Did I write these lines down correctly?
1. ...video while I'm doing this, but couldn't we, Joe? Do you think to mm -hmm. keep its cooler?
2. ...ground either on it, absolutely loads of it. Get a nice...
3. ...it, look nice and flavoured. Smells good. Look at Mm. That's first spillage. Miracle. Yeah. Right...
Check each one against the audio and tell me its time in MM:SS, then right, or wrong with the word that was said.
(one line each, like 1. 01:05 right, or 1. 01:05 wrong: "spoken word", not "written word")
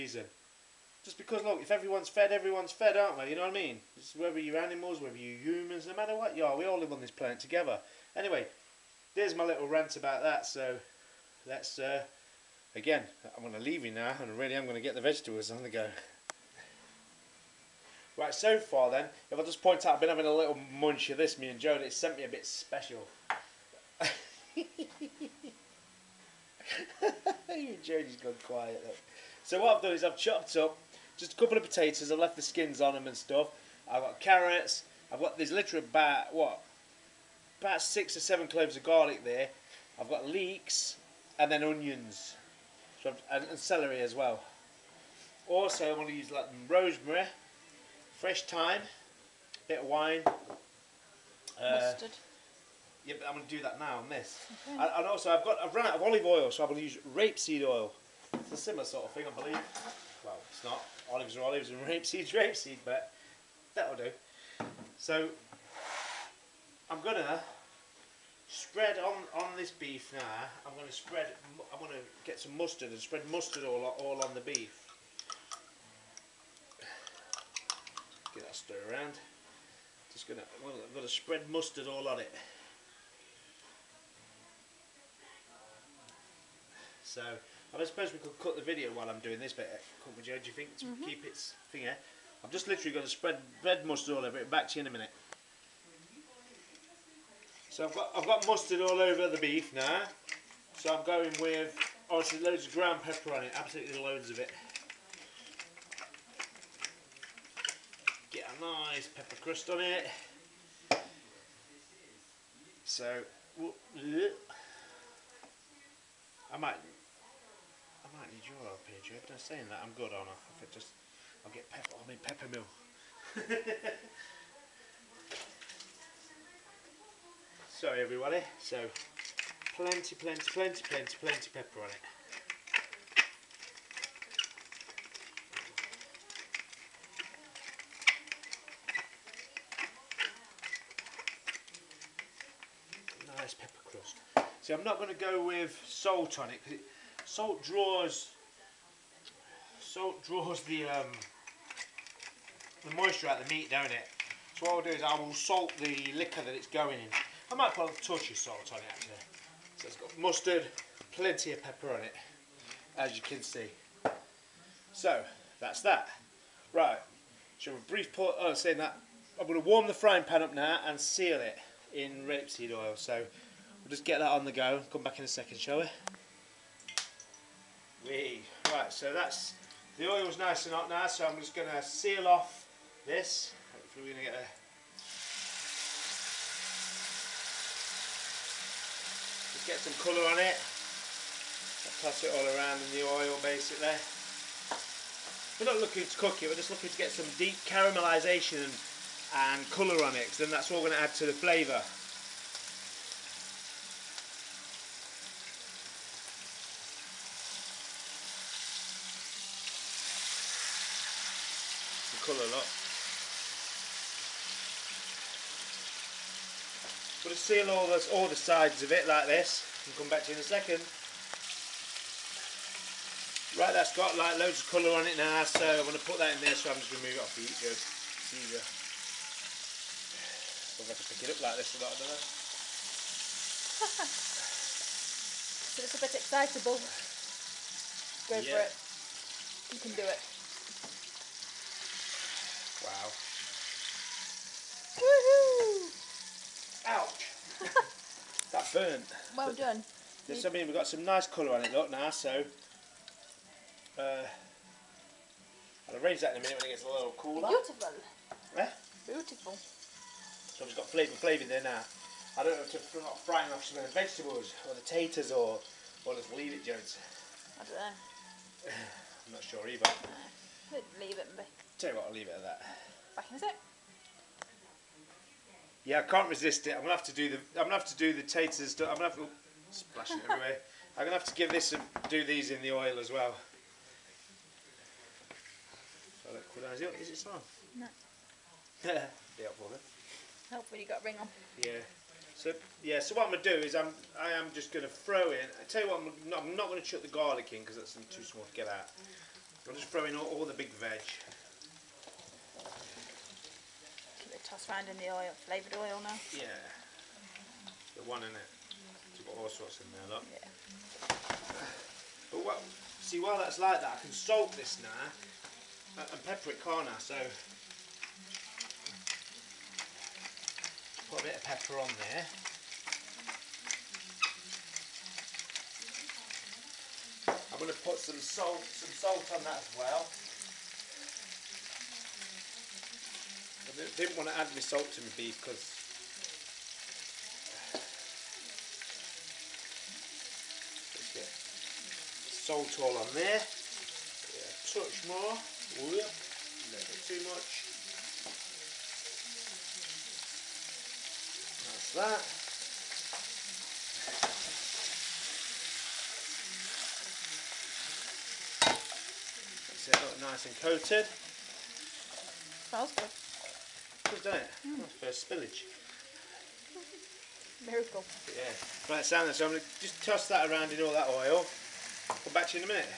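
1. 01:28 wrong: "finger", not "cooler"
2. 01:42 wrong: "pepper", not "either"
3. 05:59 wrong: "coated", not "flavoured".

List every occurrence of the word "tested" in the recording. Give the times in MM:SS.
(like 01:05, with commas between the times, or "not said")
not said.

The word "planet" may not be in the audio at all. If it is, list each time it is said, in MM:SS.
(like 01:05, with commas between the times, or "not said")
00:07.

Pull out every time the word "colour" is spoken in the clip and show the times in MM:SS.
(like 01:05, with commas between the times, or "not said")
03:10, 03:19, 03:32, 03:44, 04:11.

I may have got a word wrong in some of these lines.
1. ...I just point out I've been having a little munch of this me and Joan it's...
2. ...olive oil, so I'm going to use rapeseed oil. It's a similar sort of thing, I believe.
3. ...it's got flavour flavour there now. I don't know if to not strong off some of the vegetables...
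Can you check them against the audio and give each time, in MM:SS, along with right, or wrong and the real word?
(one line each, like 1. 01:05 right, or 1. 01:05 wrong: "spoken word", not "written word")
1. 00:19 right
2. 00:56 right
3. 04:20 wrong: "frying", not "strong".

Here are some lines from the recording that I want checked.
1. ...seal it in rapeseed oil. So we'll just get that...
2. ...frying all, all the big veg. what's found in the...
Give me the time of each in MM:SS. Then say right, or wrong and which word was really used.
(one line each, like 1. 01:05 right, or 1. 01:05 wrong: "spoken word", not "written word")
1. 02:50 right
2. 04:59 wrong: "throwing", not "frying".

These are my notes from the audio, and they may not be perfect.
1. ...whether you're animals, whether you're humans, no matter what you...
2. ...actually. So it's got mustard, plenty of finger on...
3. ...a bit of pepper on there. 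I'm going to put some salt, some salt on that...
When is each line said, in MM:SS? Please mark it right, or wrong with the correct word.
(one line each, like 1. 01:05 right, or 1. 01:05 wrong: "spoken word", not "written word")
1. 00:04 right
2. 02:38 wrong: "pepper", not "finger"
3. 05:21 right.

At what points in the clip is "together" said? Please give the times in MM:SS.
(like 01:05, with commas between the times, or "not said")
00:07.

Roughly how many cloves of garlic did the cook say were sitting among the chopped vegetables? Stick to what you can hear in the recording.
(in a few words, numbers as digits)
6 or 7.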